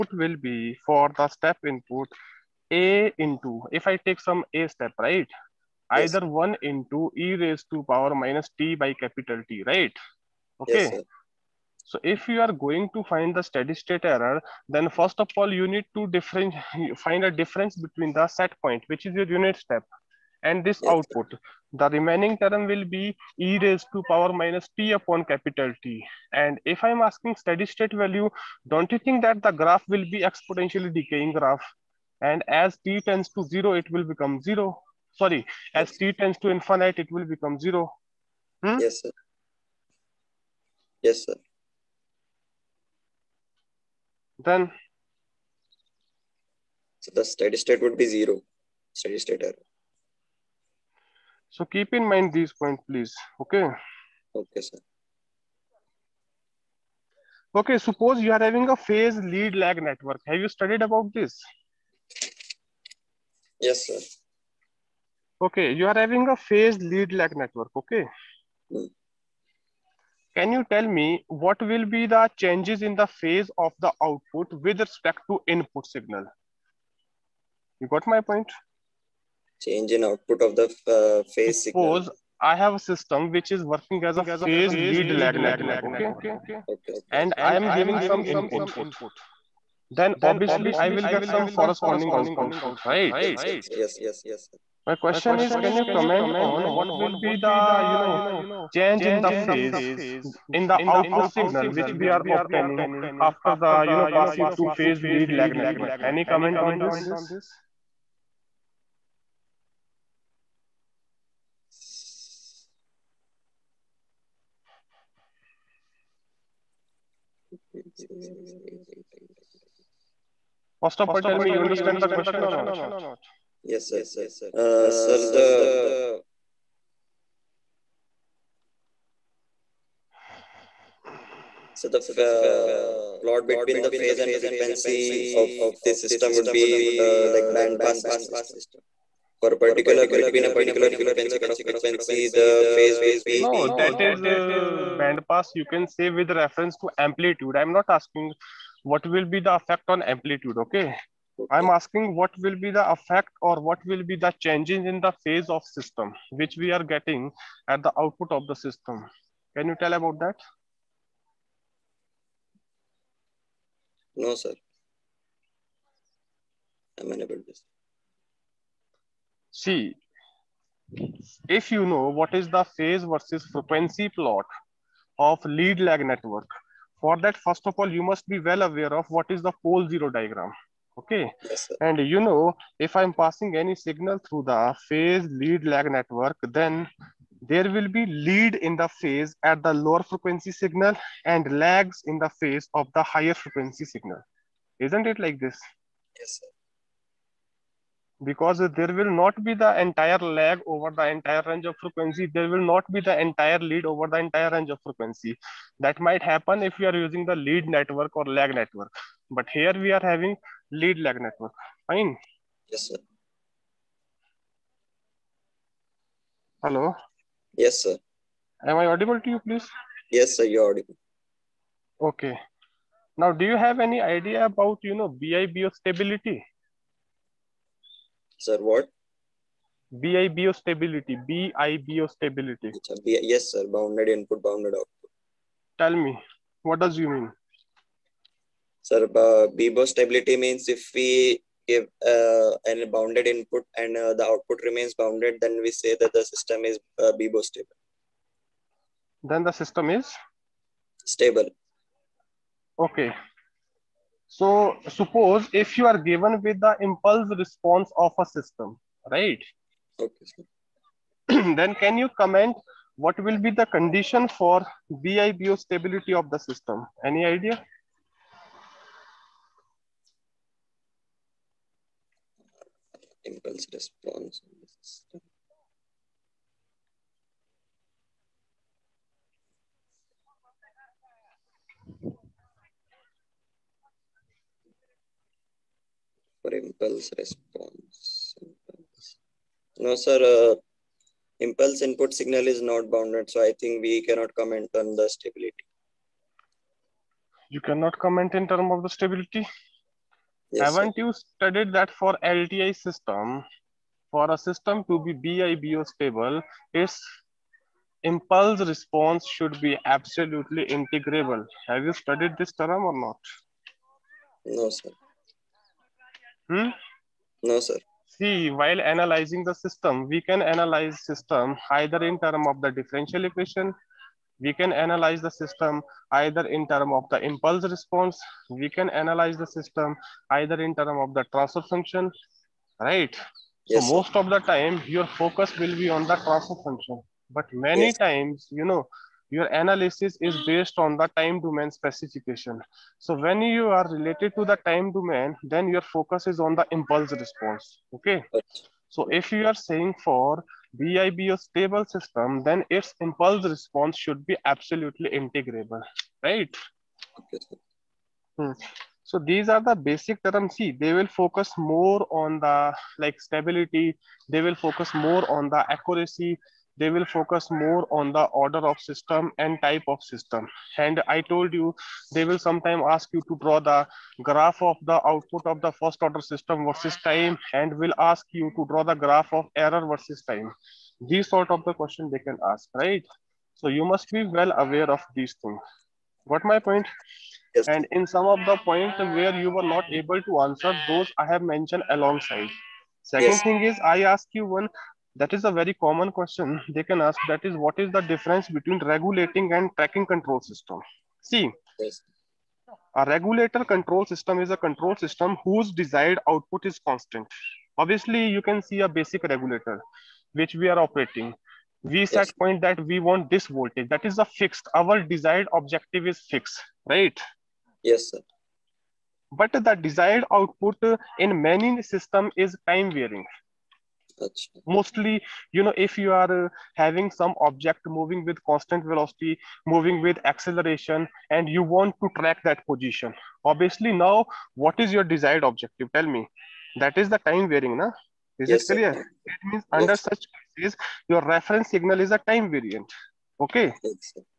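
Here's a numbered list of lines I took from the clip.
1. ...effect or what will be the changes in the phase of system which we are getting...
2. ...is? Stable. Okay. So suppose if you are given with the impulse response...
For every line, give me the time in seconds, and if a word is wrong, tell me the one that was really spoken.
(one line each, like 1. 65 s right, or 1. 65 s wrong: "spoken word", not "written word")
1. 152 s right
2. 249 s right.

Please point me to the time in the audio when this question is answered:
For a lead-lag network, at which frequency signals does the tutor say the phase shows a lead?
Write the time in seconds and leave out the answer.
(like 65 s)
189 s.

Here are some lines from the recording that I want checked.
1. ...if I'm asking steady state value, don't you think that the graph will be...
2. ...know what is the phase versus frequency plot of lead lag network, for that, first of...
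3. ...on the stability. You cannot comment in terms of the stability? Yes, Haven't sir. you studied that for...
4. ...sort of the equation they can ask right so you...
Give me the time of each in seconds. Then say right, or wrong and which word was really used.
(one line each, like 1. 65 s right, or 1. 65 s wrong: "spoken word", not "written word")
1. 26 s right
2. 171 s right
3. 294 s right
4. 381 s wrong: "question", not "equation".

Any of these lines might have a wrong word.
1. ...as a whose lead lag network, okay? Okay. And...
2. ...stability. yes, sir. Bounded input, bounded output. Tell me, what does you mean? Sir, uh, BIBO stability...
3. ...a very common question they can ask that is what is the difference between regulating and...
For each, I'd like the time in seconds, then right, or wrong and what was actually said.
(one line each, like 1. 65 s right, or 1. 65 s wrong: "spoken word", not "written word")
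1. 84 s wrong: "phase", not "whose"
2. 232 s right
3. 395 s right.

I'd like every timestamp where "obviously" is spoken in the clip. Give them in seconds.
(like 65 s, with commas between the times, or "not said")
90 s, 407 s, 433 s.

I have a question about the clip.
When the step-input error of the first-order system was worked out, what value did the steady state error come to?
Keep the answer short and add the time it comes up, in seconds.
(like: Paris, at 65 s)
0, at 46 s.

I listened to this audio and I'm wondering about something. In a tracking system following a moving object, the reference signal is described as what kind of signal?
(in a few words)
time variant.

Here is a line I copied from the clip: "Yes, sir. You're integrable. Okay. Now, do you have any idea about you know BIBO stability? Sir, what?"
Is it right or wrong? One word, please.
wrong.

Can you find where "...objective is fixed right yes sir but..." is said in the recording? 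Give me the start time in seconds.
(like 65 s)
415 s.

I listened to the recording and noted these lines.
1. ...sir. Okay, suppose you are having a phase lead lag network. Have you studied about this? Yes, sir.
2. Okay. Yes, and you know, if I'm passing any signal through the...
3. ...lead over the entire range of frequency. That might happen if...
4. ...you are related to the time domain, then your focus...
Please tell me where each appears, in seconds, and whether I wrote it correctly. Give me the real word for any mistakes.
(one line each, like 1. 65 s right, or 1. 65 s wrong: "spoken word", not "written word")
1. 54 s right
2. 180 s right
3. 203 s right
4. 343 s right.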